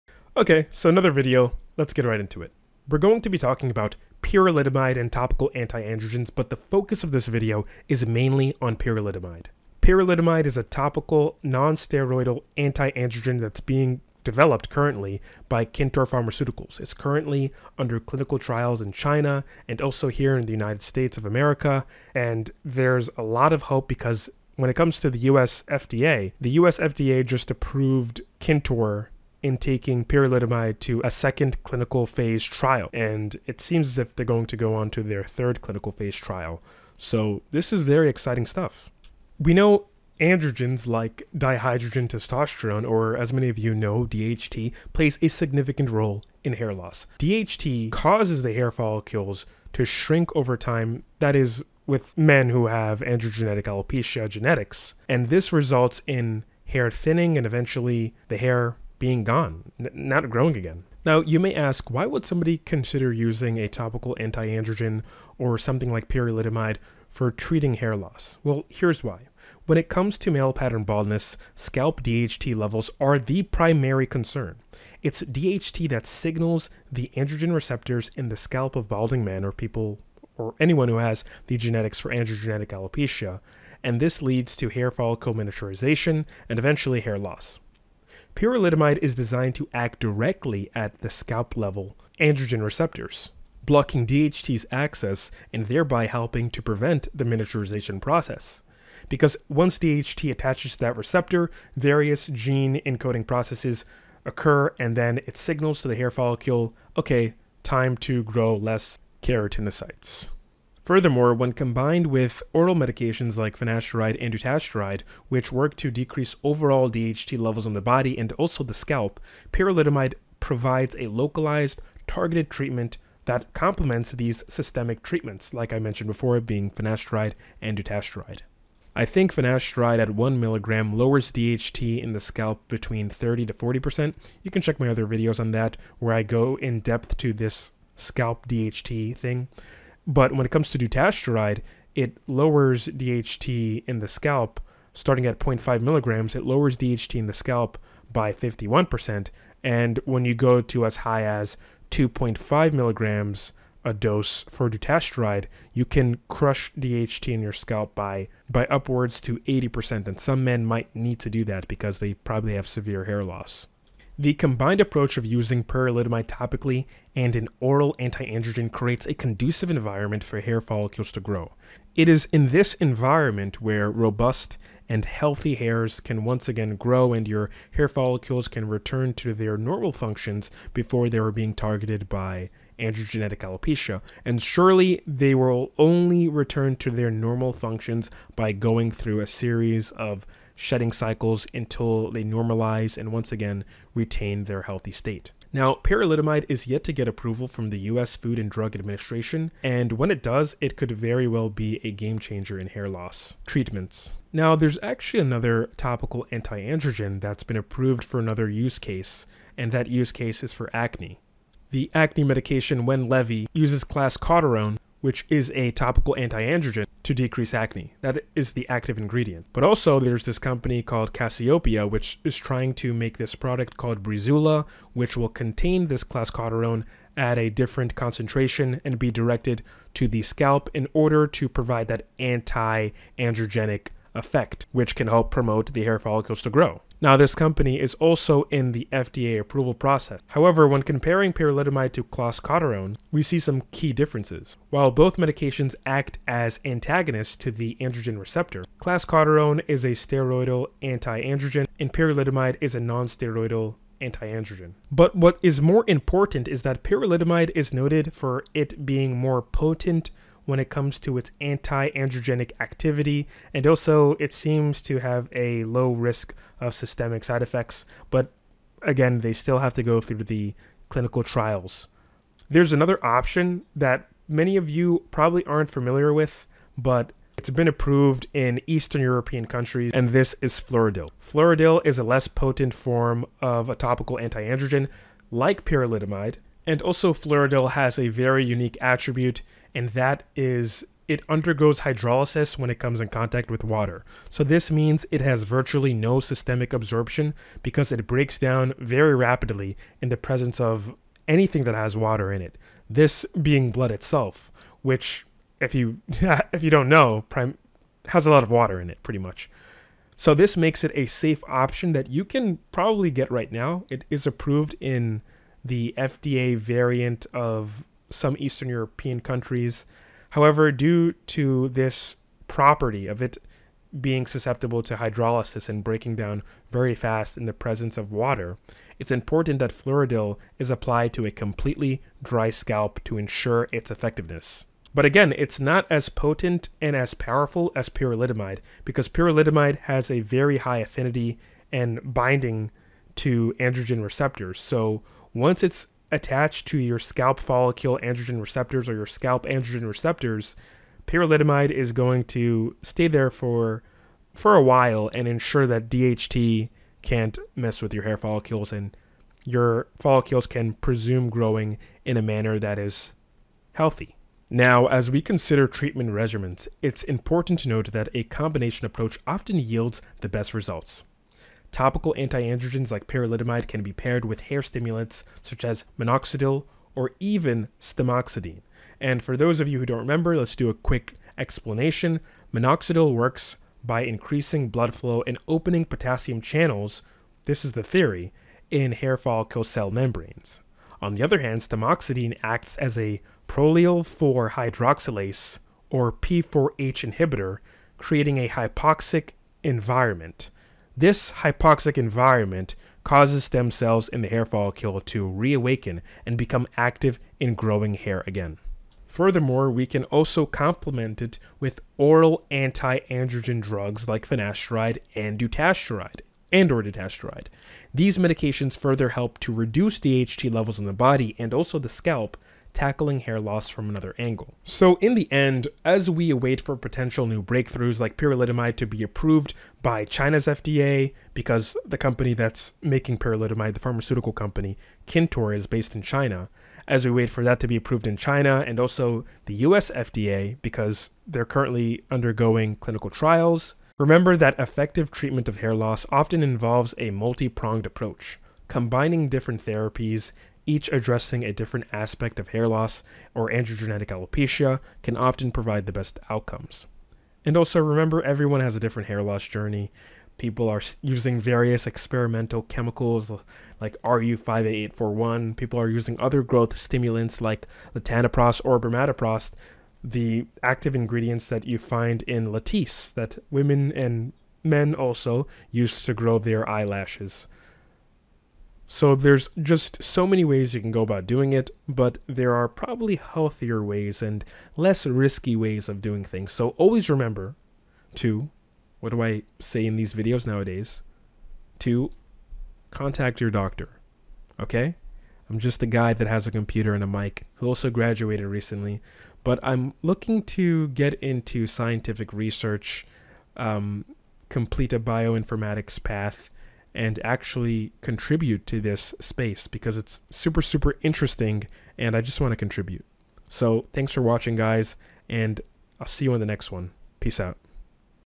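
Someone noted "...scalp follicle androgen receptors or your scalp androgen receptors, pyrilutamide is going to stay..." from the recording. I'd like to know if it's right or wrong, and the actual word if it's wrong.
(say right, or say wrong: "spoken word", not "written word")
right.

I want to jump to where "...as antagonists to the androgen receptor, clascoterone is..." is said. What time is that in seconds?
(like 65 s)
246 s.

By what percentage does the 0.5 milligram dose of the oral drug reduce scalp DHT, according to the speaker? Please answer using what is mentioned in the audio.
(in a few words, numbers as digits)
51%.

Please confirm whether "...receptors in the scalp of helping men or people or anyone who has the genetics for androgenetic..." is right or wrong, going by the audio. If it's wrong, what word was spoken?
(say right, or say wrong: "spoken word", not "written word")
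wrong: "balding", not "helping".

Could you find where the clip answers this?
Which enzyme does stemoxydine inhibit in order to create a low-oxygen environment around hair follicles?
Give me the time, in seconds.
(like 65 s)
393 s.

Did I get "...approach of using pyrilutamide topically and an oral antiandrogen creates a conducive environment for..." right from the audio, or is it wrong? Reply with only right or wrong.
right.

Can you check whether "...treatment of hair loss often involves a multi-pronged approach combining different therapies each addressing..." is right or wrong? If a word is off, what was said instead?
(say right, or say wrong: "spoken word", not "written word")
right.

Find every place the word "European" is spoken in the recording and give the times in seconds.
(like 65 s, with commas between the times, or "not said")
279 s, 318 s.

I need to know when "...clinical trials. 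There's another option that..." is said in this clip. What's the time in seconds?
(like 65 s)
270 s.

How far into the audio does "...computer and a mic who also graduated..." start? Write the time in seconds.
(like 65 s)
496 s.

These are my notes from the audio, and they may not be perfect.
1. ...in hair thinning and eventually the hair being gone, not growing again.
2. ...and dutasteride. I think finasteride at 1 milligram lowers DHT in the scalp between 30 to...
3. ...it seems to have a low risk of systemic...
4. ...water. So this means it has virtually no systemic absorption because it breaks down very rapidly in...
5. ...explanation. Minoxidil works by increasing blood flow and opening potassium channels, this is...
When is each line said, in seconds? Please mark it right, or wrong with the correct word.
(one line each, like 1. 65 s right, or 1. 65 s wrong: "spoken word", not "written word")
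1. 56 s right
2. 127 s right
3. 264 s right
4. 293 s right
5. 381 s right.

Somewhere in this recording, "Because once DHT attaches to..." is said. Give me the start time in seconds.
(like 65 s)
99 s.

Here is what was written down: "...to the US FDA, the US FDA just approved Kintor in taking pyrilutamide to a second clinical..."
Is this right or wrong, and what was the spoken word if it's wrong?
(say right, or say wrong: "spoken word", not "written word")
right.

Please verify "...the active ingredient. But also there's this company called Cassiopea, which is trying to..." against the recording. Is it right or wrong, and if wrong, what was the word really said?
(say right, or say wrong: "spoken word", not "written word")
right.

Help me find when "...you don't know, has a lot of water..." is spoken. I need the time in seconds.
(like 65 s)
306 s.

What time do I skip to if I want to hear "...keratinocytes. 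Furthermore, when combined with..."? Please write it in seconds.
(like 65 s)
109 s.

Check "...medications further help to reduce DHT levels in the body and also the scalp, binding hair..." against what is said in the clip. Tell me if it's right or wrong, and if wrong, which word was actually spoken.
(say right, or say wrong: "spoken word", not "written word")
wrong: "tackling", not "binding".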